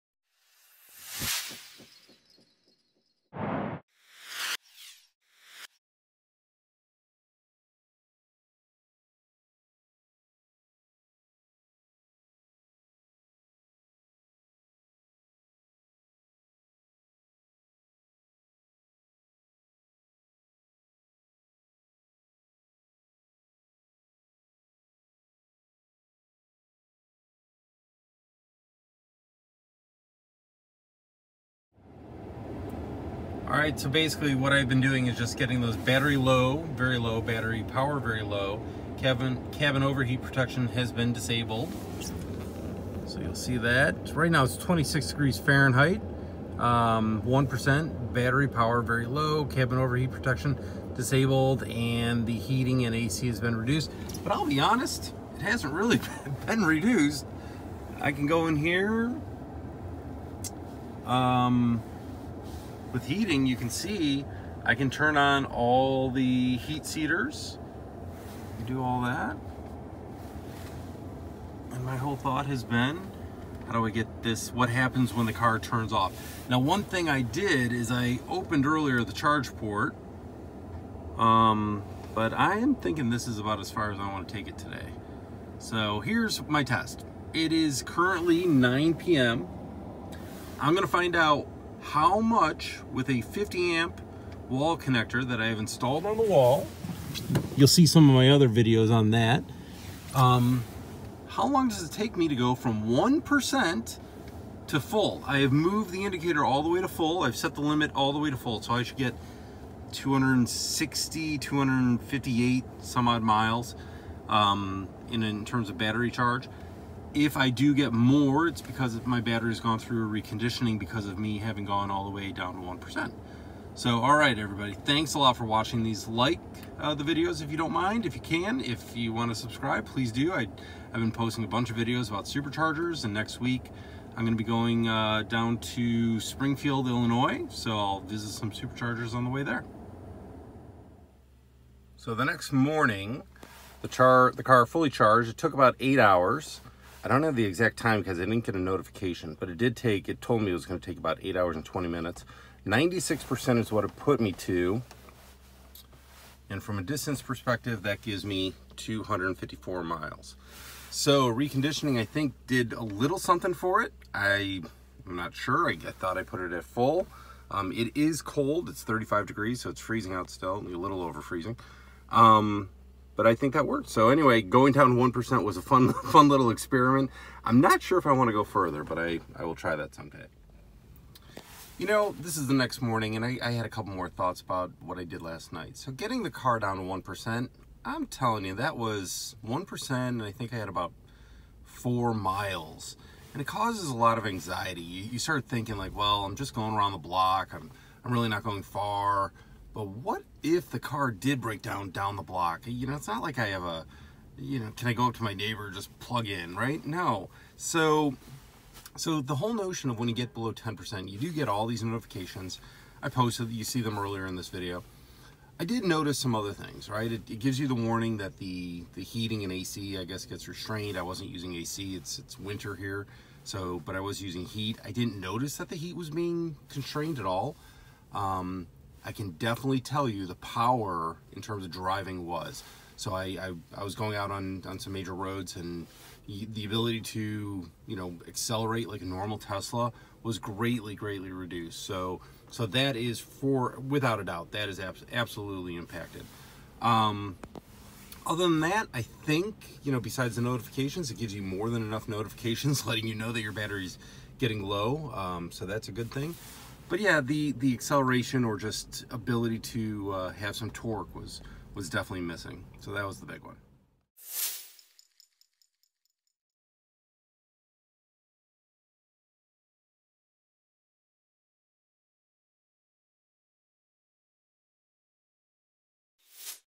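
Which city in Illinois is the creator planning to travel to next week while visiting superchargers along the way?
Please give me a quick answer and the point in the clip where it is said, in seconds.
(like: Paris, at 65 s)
Springfield, at 136 s.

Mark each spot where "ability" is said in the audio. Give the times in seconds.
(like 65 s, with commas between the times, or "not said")
236 s, 259 s.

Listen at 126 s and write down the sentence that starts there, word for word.
Like uh, the videos if you don't mind, if you can.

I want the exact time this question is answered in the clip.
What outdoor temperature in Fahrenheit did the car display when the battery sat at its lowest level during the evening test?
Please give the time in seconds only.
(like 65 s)
44 s.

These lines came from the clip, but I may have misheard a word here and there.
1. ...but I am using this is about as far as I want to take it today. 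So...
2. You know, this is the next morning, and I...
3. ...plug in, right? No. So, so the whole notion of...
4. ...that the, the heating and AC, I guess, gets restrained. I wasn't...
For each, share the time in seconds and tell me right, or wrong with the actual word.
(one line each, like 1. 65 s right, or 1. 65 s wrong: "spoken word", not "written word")
1. 82 s wrong: "thinking", not "using"
2. 181 s right
3. 205 s right
4. 218 s right.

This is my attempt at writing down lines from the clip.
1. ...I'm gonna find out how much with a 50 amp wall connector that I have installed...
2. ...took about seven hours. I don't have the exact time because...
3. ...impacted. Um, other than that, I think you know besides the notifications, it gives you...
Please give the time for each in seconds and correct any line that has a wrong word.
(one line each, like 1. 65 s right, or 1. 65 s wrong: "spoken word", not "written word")
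1. 90 s right
2. 145 s wrong: "eight", not "seven"
3. 245 s right.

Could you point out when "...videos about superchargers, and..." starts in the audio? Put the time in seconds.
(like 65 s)
131 s.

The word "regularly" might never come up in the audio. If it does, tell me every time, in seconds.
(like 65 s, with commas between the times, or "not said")
not said.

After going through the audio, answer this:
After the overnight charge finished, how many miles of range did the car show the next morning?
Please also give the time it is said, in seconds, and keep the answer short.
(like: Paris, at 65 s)
254 miles, at 158 s.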